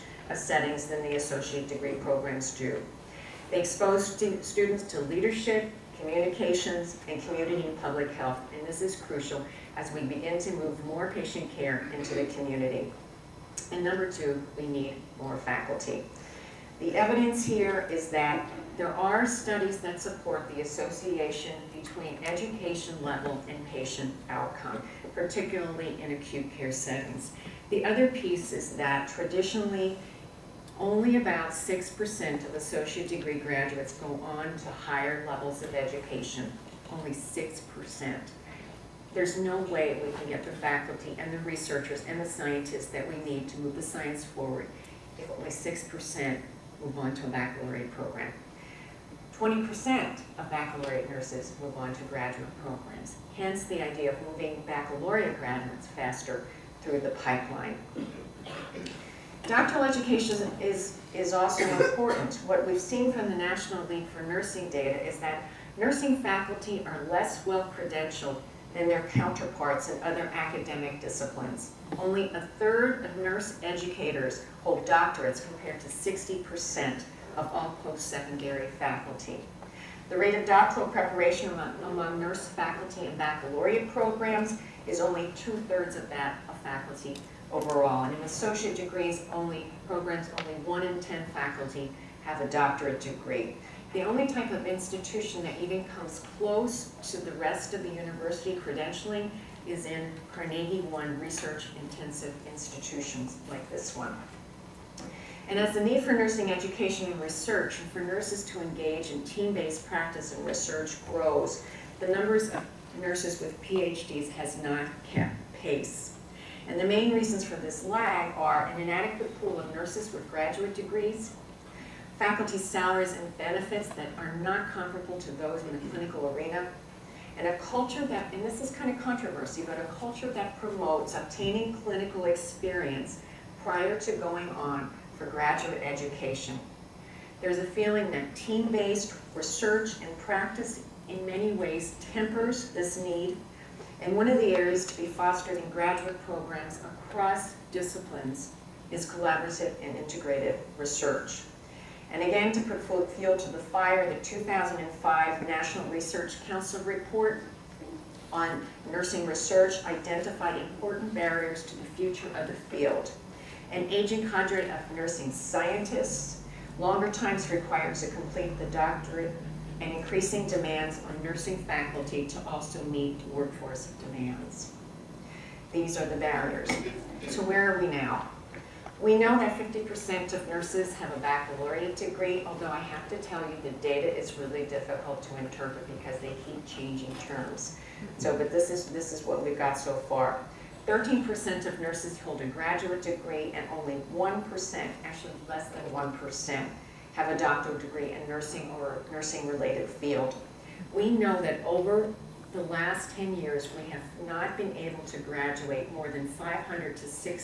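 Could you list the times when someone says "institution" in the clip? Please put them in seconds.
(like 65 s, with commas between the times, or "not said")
94 s, 102 s.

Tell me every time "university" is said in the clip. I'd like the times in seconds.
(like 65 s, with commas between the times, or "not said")
97 s.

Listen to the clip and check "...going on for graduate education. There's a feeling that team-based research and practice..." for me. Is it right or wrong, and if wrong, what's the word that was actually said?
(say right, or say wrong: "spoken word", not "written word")
right.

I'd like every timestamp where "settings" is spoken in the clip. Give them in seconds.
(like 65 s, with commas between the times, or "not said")
0 s, 26 s.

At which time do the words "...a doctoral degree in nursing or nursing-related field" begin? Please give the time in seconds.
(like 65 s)
197 s.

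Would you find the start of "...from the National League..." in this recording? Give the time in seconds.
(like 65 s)
63 s.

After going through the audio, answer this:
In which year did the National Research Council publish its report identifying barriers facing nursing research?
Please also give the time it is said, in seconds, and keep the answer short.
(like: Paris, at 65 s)
2005, at 154 s.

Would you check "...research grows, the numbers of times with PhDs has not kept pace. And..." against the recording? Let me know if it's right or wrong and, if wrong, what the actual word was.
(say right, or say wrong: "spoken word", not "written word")
wrong: "nurses", not "times".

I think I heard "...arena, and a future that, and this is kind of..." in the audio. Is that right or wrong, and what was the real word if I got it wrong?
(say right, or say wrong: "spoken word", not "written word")
wrong: "culture", not "future".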